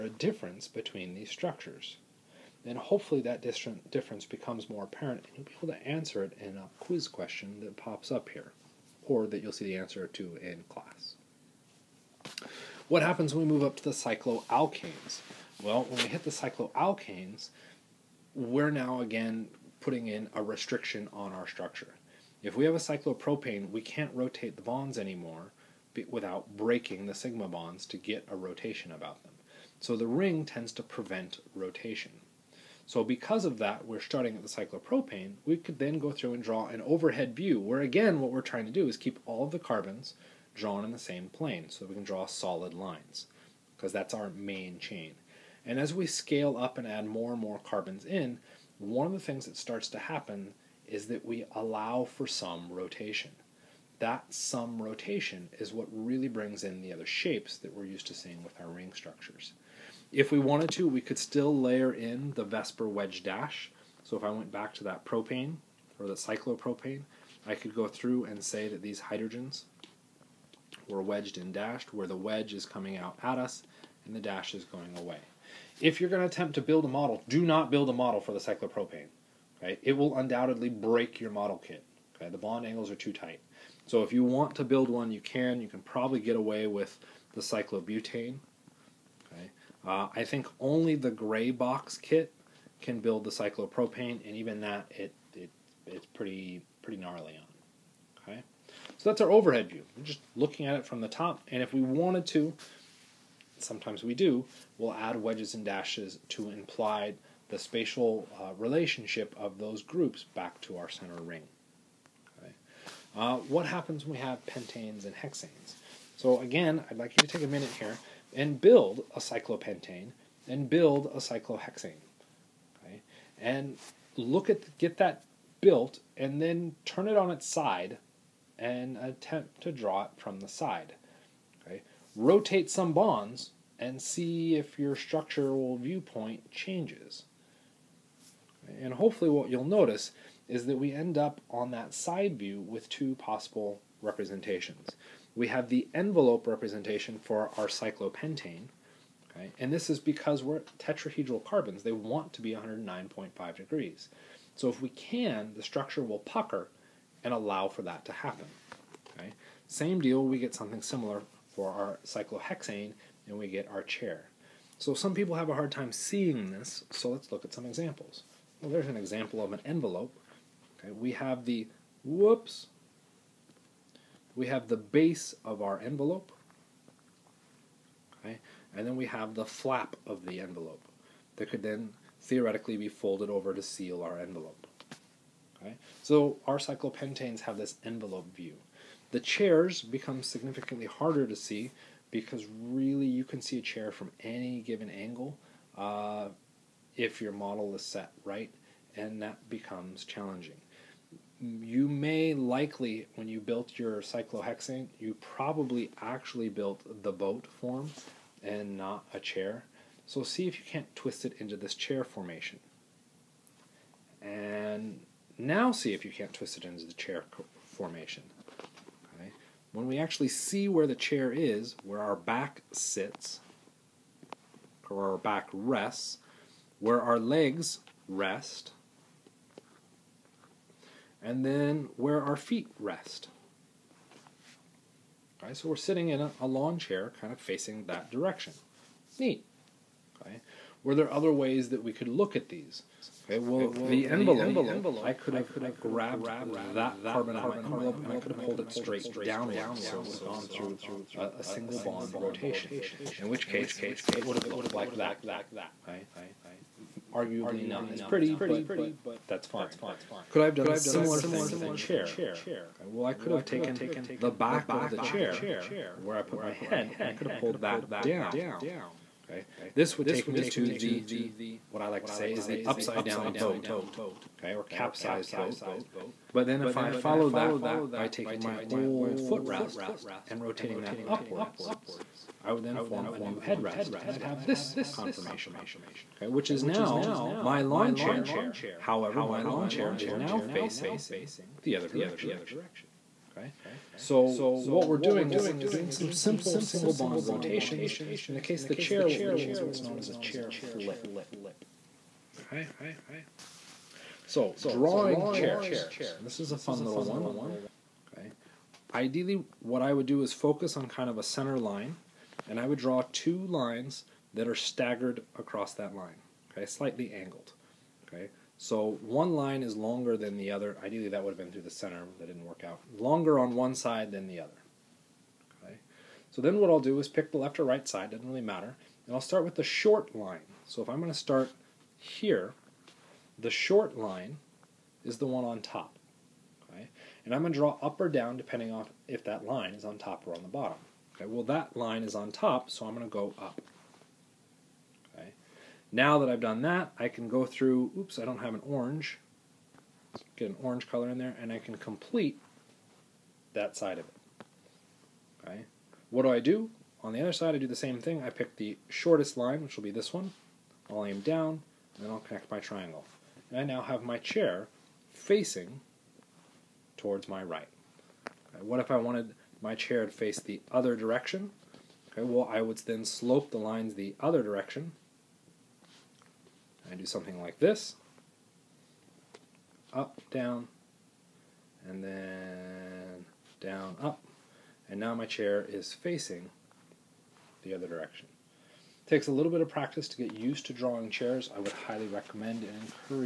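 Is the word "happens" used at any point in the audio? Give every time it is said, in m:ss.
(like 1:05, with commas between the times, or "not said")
0:13, 0:49, 1:53, 2:38.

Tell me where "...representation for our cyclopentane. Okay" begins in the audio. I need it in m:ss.
2:26.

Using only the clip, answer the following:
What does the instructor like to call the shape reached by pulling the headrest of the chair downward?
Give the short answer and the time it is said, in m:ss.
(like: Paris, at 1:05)
upside down boat, at 4:32.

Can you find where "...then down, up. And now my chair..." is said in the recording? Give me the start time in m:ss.
6:22.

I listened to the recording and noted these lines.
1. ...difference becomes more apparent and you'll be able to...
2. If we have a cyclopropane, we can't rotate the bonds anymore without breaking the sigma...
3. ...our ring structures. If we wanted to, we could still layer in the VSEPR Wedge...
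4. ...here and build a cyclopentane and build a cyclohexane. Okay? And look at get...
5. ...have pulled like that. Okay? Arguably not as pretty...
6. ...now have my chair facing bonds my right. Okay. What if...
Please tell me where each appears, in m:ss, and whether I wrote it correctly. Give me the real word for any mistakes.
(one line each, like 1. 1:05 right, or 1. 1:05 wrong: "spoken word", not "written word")
1. 0:03 right
2. 0:22 right
3. 0:58 right
4. 1:57 right
5. 4:14 wrong: "looked", not "pulled"
6. 6:03 wrong: "towards", not "bonds".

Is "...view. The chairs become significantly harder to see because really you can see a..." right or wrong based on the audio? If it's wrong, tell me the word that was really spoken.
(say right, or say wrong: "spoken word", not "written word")
right.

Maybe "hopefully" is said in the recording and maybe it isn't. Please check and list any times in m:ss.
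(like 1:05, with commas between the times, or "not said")
0:02, 2:18.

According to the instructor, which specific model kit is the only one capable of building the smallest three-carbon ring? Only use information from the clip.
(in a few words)
gray box kit.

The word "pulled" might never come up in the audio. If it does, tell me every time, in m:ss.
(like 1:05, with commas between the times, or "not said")
4:08, 4:27.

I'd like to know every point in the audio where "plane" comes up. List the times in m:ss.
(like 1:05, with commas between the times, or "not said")
0:41.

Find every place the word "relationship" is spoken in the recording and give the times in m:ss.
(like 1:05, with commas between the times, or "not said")
1:48.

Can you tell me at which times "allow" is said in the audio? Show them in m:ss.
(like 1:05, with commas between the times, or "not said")
0:51, 2:37.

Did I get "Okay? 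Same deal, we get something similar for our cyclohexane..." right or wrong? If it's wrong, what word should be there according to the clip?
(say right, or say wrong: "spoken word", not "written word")
right.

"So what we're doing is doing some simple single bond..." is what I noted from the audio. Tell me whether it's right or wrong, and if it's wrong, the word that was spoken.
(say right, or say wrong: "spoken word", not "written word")
right.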